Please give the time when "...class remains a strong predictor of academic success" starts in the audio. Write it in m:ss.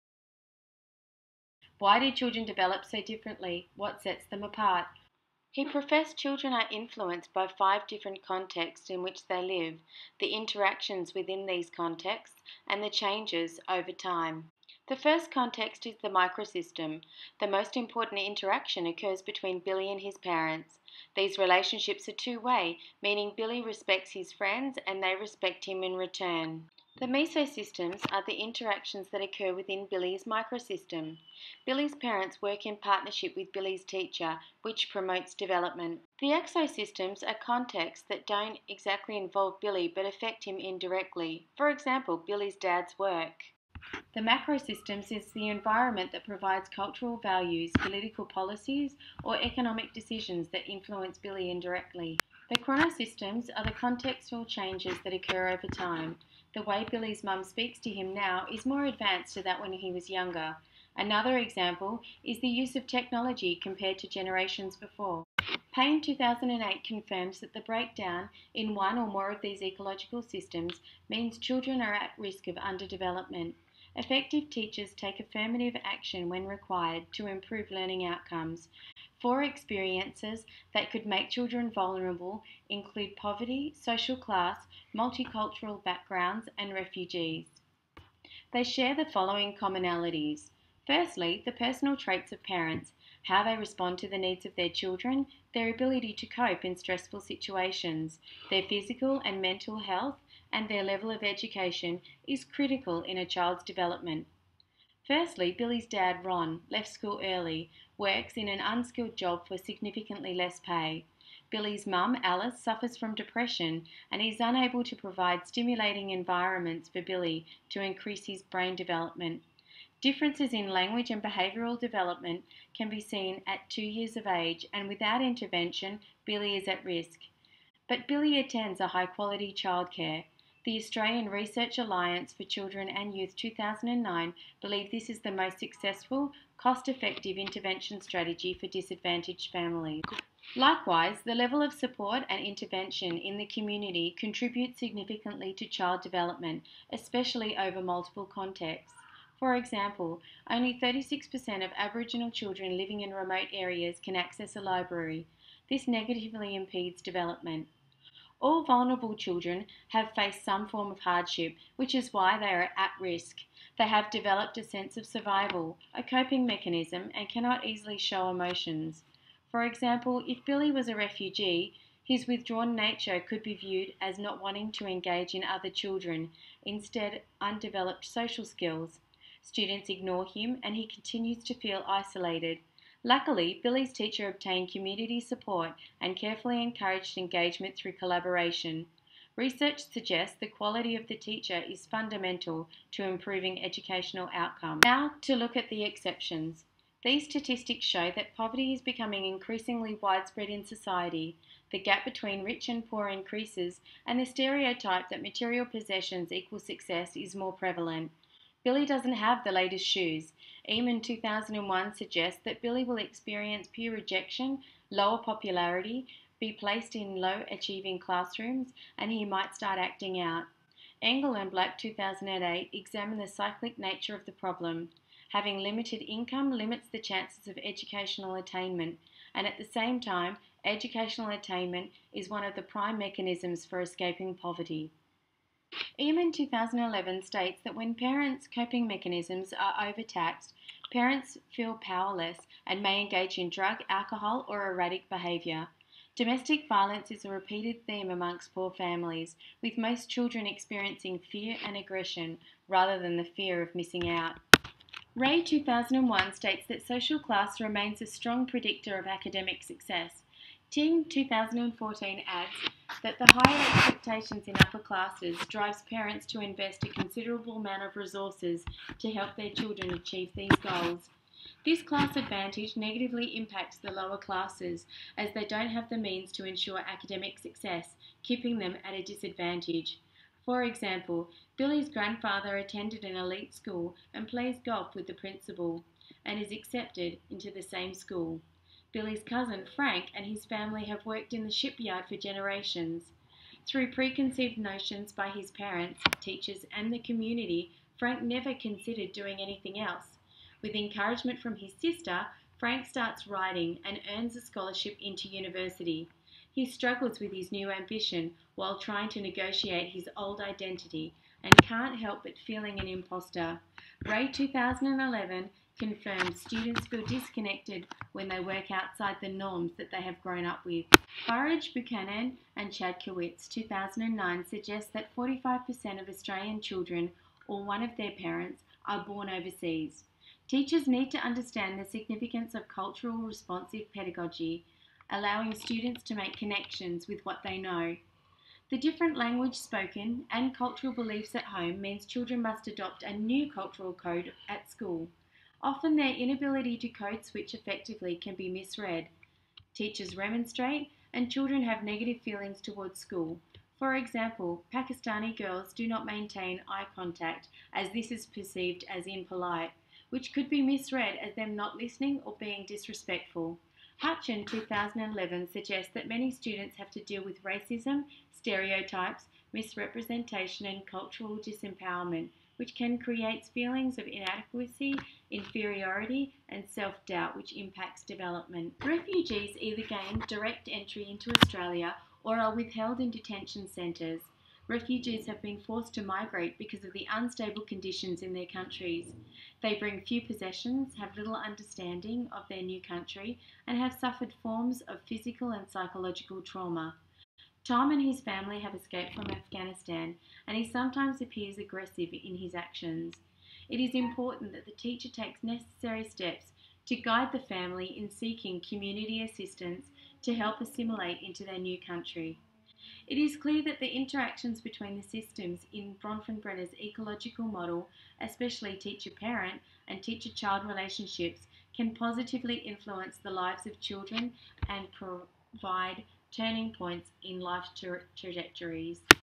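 4:17.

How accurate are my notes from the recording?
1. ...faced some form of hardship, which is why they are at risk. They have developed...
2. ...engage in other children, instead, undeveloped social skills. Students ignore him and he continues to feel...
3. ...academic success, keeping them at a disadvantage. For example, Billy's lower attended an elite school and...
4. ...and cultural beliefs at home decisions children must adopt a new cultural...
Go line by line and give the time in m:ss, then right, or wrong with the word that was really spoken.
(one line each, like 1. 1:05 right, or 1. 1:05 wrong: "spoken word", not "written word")
1. 2:40 right
2. 2:54 right
3. 4:36 wrong: "grandfather", not "lower"
4. 5:40 wrong: "means", not "decisions".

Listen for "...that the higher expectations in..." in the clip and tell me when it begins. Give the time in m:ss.
4:23.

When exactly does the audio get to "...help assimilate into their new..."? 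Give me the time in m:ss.
6:50.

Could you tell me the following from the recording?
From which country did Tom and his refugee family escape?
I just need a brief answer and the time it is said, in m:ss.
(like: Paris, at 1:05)
Afghanistan, at 6:39.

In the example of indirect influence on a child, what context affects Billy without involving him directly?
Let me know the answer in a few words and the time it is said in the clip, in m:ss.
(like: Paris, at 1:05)
Billy's dad's work, at 0:42.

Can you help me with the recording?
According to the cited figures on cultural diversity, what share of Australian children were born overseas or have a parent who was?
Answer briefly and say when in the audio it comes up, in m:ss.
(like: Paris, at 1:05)
45%, at 5:25.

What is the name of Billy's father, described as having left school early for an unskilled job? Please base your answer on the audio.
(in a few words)
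Ron.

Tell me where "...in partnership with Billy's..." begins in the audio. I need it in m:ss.
0:32.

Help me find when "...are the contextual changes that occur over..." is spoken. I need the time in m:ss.
0:53.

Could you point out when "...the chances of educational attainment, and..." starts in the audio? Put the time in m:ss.
3:46.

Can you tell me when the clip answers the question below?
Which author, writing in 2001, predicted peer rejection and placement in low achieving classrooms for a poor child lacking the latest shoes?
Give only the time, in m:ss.
3:30.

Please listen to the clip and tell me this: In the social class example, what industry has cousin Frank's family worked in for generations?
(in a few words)
the shipyard.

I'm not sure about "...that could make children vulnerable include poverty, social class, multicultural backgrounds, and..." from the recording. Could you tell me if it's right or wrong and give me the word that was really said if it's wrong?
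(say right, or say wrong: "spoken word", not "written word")
right.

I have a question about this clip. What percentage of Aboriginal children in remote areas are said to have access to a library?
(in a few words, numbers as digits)
36%.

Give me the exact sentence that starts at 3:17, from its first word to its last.
These statistics show that poverty is becoming increasingly widespread in society.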